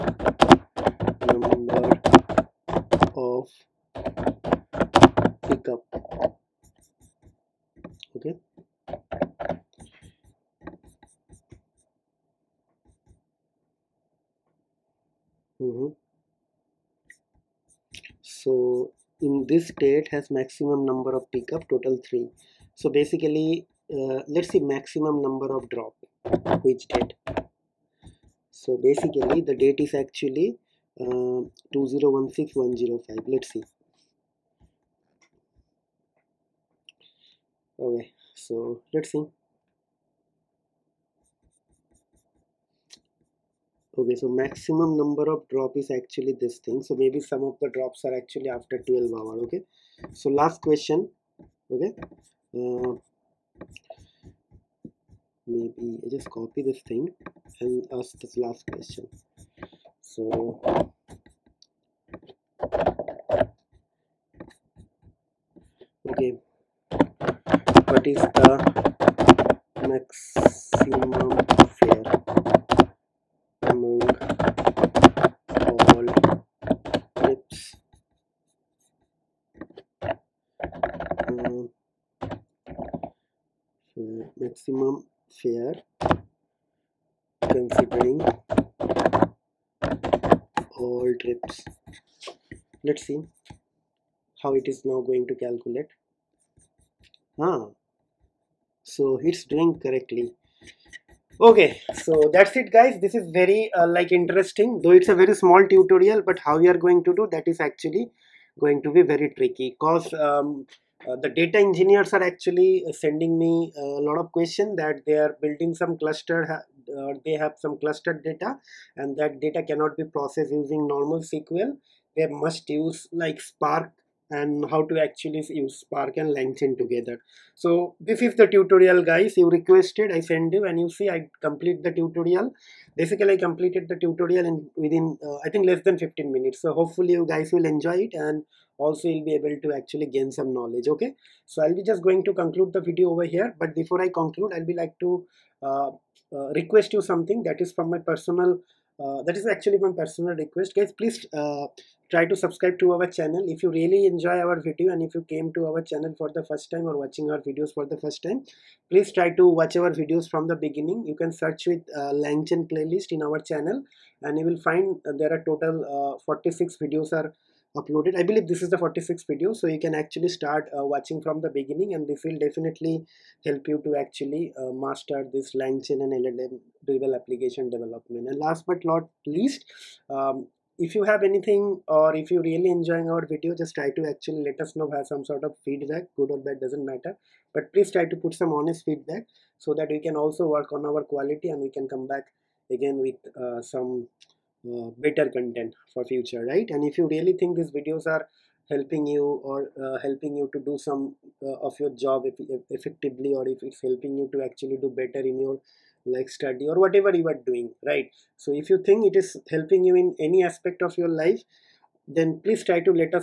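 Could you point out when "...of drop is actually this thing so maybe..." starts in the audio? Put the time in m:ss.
0:45.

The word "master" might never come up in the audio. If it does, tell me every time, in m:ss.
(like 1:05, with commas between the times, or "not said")
2:54.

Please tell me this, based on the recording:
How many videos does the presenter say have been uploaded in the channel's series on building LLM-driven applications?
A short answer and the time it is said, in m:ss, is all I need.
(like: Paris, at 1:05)
46, at 2:46.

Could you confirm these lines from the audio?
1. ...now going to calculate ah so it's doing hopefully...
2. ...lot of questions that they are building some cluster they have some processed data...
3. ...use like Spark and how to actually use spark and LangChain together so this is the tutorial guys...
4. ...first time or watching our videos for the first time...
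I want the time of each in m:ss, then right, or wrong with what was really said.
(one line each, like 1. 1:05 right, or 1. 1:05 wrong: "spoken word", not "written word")
1. 1:34 wrong: "correctly", not "hopefully"
2. 1:54 wrong: "clustered", not "processed"
3. 2:02 right
4. 2:36 right.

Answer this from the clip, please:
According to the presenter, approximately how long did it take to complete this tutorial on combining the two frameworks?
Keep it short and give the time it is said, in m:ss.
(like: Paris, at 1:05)
less than 15 minutes, at 2:15.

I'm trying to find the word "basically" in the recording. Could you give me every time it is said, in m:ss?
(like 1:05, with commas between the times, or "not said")
0:22, 0:28, 2:12.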